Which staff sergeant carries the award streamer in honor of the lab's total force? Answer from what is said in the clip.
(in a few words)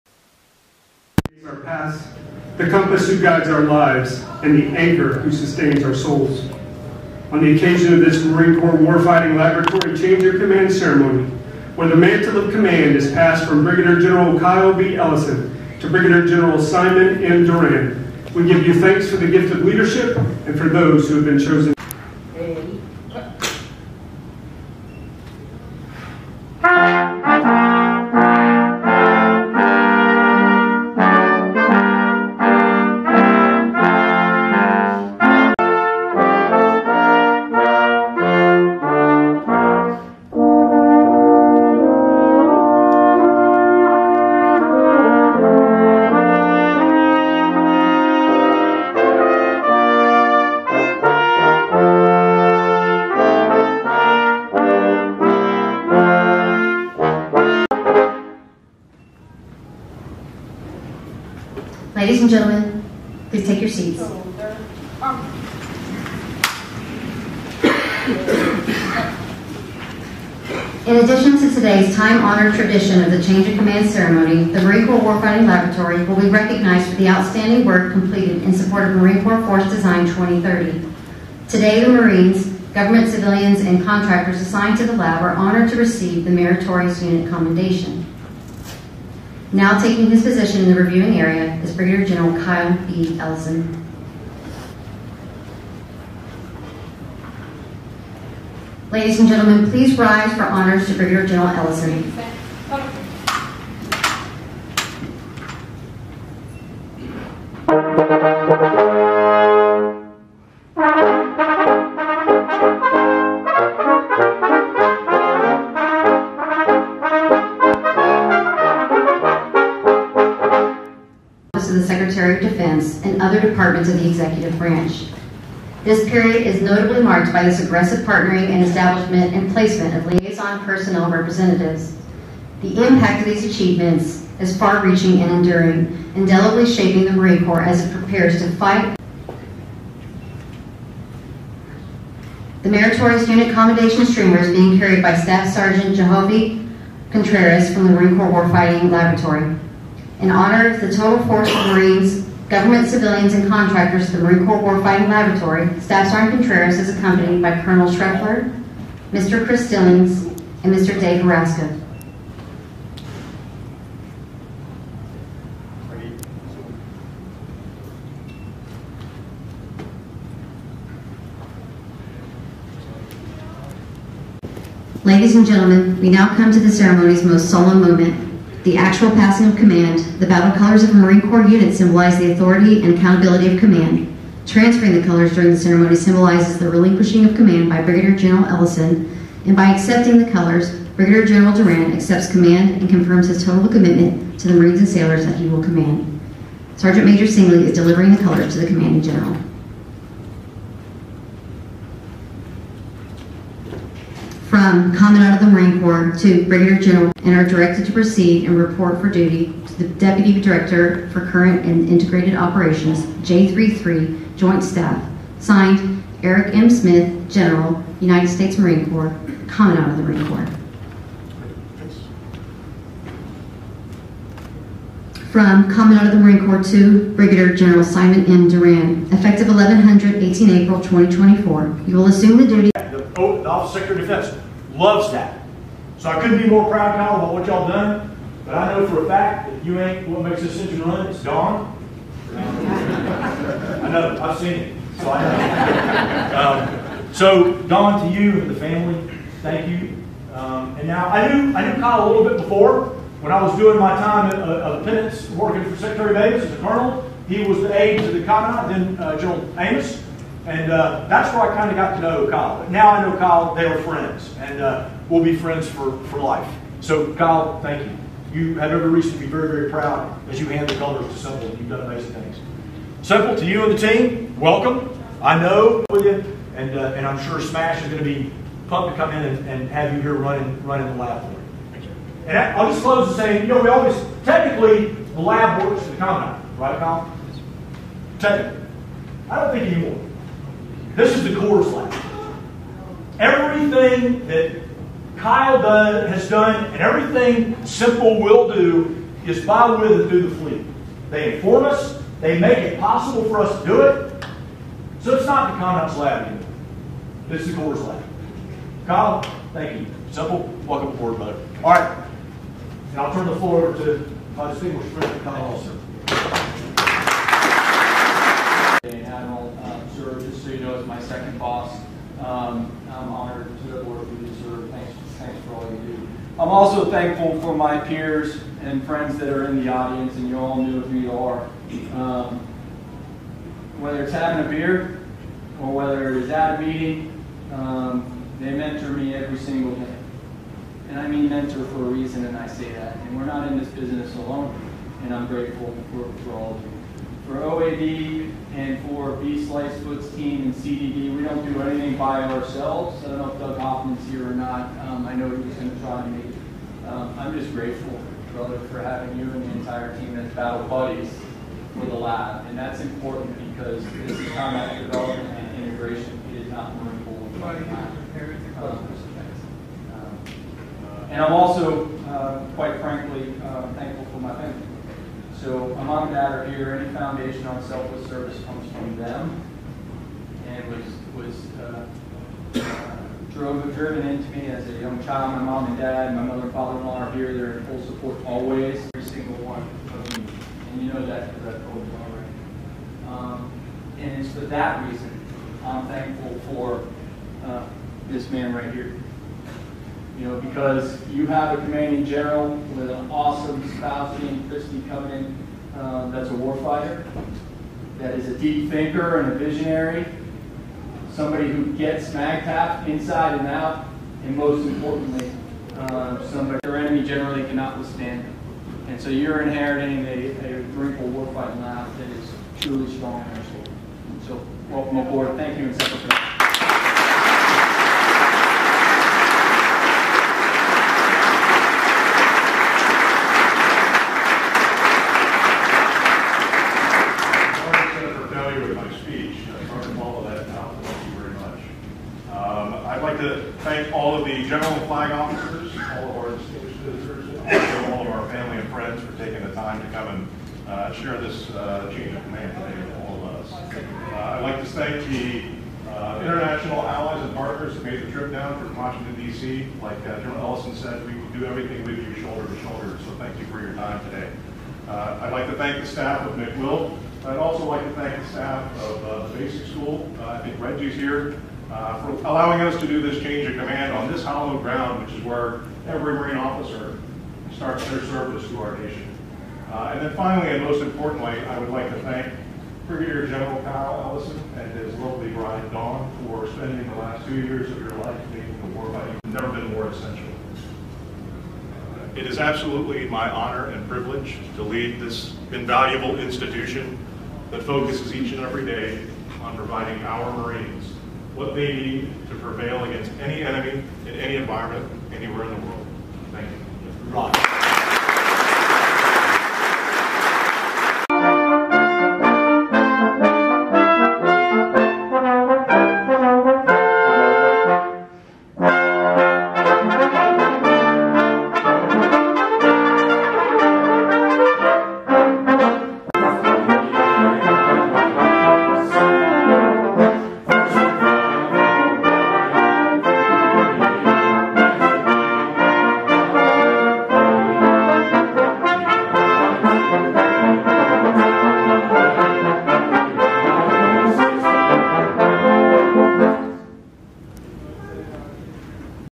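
Jehovah Contreras.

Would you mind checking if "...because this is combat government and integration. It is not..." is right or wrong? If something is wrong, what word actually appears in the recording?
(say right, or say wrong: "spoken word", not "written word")
wrong: "development", not "government".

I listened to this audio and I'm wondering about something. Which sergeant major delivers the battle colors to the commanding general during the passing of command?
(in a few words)
Sergeant Major Singley.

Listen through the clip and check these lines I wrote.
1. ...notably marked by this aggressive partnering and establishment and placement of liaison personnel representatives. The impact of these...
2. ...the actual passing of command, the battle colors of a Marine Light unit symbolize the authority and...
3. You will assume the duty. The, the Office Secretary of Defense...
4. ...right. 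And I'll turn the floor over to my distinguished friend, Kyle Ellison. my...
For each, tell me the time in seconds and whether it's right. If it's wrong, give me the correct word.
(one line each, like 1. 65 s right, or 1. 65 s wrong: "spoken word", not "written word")
1. 126 s right
2. 178 s wrong: "Corps", not "Light"
3. 231 s right
4. 311 s right.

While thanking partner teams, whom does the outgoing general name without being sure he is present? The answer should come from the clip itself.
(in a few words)
Doug Hoffman.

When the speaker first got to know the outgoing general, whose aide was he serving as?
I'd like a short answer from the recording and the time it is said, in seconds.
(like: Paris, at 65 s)
General Amos, at 259 s.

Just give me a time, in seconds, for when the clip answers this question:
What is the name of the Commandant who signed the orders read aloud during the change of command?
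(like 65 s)
216 s.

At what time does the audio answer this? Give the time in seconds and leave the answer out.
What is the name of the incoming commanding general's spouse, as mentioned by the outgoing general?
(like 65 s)
404 s.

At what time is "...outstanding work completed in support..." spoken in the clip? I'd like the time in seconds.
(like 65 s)
77 s.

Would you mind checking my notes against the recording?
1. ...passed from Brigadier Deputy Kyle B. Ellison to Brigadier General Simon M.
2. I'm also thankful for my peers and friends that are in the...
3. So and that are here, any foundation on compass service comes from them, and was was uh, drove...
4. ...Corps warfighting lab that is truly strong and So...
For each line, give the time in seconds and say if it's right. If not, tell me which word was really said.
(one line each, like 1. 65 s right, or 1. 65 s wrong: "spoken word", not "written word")
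1. 13 s wrong: "General", not "Deputy"
2. 326 s right
3. 375 s wrong: "selfless", not "compass"
4. 420 s right.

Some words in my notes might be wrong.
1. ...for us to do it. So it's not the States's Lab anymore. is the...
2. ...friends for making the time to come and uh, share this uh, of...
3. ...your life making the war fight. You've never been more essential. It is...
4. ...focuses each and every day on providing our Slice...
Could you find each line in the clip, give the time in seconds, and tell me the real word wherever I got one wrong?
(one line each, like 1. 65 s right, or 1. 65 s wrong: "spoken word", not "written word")
1. 303 s wrong: "Conduct", not "States"
2. 448 s wrong: "taking", not "making"
3. 487 s right
4. 497 s wrong: "Marines", not "Slice".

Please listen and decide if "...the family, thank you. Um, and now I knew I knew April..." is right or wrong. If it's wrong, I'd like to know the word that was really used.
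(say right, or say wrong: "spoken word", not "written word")
wrong: "Kyle", not "April".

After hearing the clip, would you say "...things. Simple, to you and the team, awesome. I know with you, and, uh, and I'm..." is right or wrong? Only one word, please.
wrong.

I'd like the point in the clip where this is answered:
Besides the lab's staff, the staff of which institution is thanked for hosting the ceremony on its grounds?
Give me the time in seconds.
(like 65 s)
469 s.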